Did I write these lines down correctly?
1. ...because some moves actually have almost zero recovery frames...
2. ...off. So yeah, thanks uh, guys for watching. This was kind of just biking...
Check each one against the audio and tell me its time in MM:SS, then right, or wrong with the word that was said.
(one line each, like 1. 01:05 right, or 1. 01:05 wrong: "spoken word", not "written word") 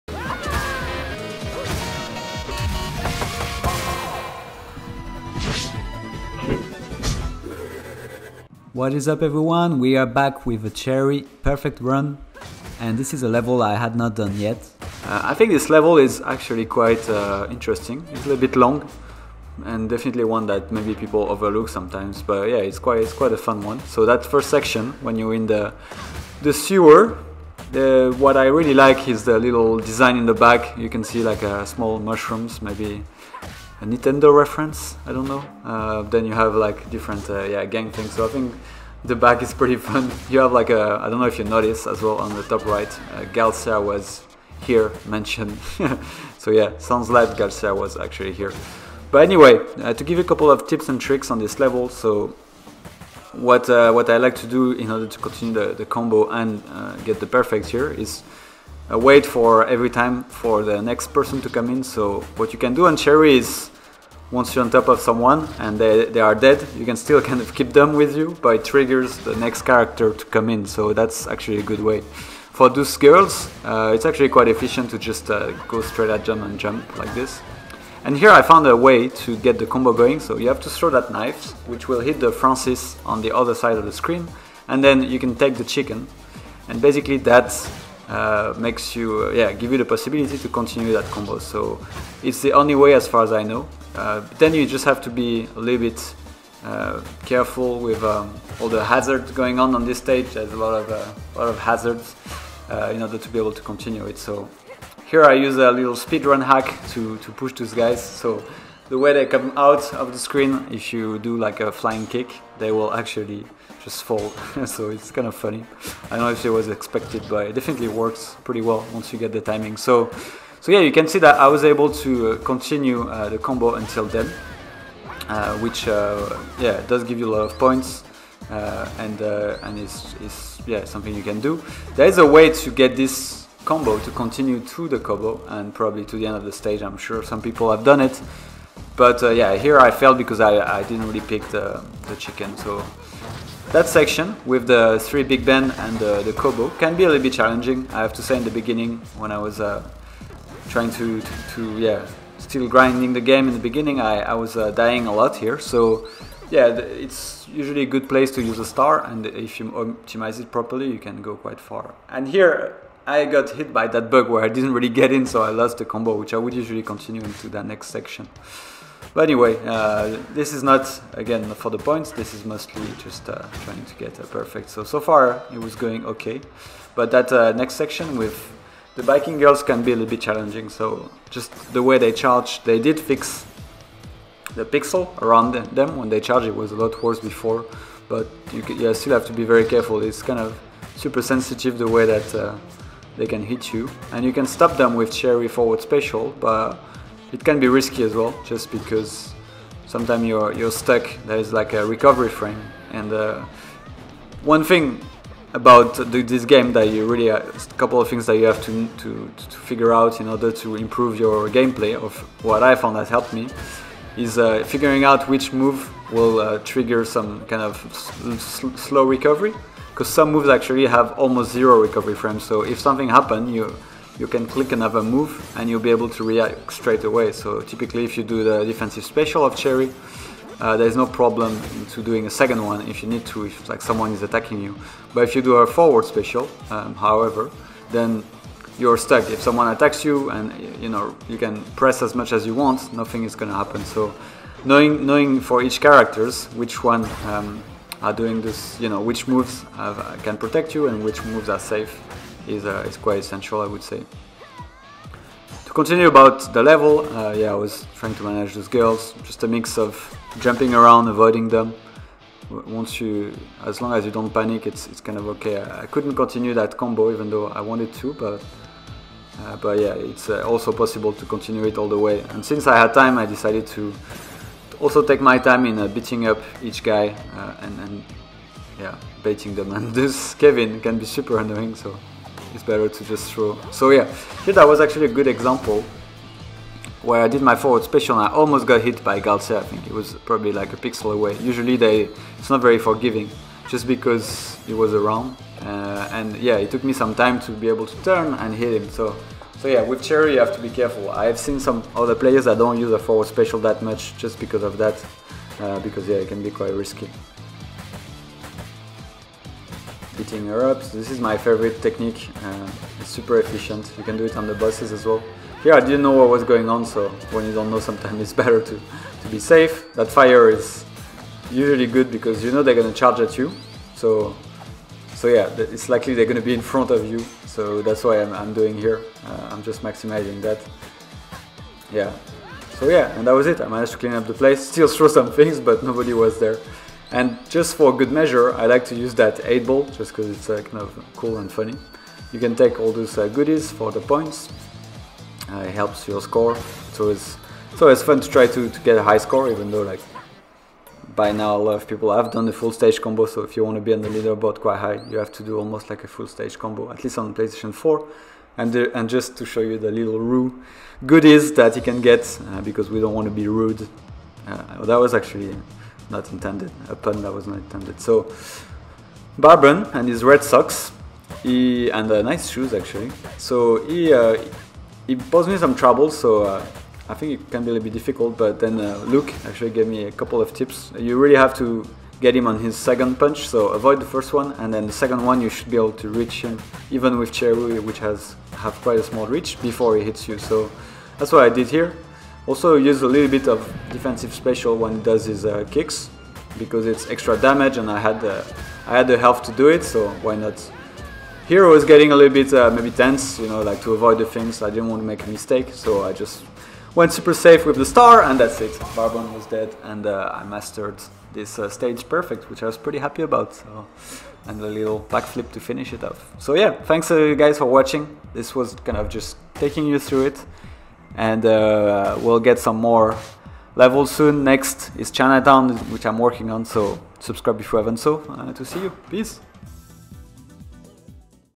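1. 03:39 right
2. 06:56 wrong: "taking", not "biking".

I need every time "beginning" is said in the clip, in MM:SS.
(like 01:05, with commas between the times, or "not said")
02:28, 02:33.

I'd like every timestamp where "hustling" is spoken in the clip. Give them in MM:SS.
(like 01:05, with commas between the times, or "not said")
not said.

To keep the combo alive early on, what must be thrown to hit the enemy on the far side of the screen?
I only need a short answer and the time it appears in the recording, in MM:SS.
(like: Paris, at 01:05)
Knife, at 01:21.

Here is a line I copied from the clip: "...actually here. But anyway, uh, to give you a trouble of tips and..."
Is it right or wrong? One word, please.
wrong.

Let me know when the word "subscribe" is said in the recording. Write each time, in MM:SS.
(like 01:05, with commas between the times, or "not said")
07:07.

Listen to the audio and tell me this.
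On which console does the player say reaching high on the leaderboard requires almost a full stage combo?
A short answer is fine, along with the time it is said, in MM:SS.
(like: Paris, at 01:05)
PlayStation 4, at 05:57.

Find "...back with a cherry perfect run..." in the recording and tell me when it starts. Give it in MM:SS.
00:10.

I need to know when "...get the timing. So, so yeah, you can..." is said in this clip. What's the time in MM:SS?
01:59.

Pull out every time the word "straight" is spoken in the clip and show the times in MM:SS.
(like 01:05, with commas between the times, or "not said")
01:15, 03:46.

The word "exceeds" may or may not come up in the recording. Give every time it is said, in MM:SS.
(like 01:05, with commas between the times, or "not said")
not said.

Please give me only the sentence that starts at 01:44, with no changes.
So here I use a little speedrun hack to to push those guys.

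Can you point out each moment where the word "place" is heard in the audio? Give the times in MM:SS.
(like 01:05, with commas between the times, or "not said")
02:38, 05:34.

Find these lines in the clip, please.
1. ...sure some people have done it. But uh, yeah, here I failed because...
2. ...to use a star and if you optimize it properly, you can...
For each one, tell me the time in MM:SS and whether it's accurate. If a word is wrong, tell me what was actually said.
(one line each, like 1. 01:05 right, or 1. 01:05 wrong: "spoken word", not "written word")
1. 02:16 right
2. 02:38 right.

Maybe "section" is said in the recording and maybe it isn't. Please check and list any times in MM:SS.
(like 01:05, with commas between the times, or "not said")
00:24, 02:23, 02:47, 02:57.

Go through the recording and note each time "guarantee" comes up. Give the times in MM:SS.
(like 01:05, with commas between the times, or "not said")
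not said.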